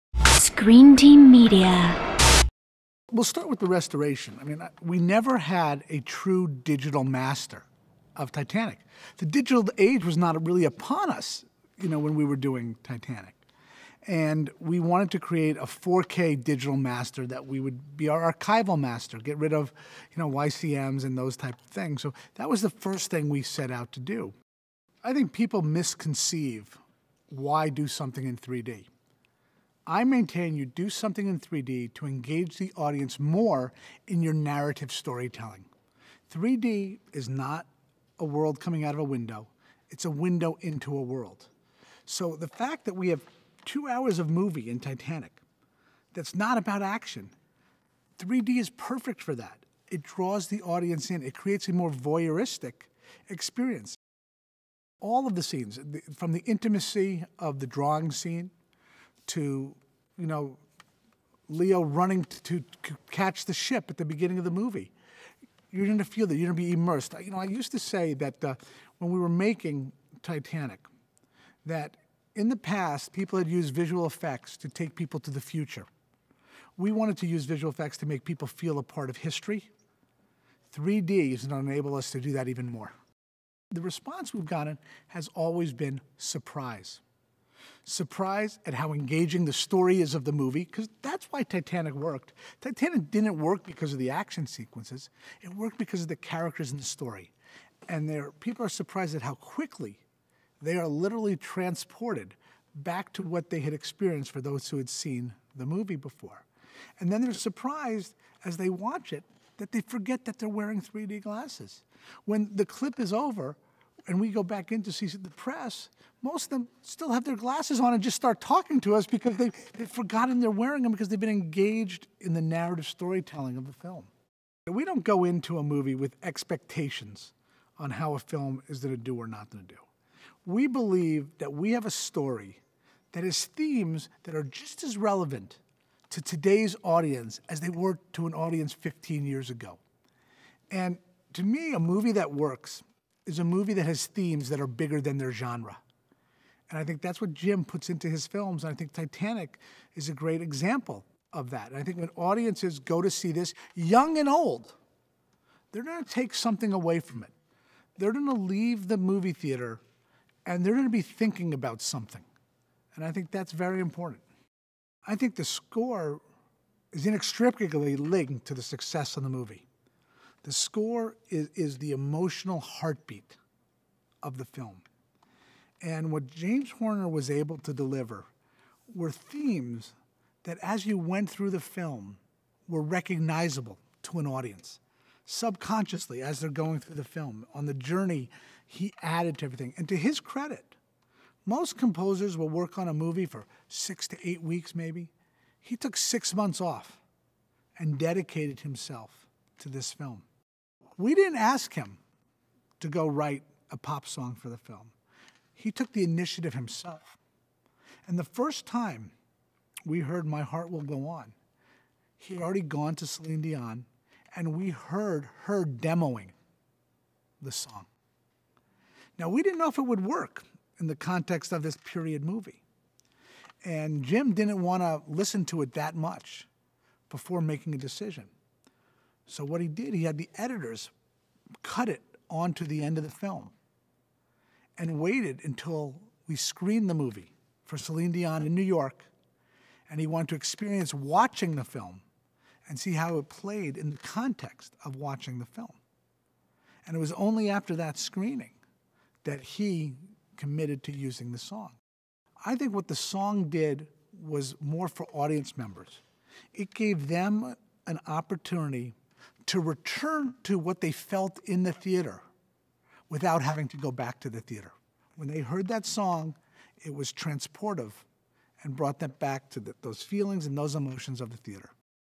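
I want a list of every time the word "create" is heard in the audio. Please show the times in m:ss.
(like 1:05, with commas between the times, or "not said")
0:15, 0:51.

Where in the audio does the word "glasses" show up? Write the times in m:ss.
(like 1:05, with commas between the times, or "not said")
1:51, 1:57.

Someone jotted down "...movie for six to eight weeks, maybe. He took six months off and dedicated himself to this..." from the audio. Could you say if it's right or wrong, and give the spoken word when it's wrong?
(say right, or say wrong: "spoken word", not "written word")
right.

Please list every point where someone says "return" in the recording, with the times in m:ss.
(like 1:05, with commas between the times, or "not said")
4:19.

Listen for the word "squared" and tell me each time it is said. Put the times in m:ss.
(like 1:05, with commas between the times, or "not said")
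not said.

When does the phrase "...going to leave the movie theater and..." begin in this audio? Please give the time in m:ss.
2:38.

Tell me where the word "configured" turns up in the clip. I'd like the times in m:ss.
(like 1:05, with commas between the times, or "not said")
not said.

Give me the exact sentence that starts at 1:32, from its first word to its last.
Titanic didn't work because of the action sequences, it worked because of the characters in the story.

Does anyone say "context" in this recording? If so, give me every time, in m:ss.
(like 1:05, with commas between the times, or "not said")
3:40, 4:03.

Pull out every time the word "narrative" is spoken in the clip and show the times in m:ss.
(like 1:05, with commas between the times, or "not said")
0:34, 2:02.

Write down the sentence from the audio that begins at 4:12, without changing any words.
I think what the song did was more for audience members.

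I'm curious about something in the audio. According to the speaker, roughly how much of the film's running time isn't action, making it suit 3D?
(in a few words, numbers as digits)
2 hours.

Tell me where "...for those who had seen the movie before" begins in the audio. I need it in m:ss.
1:44.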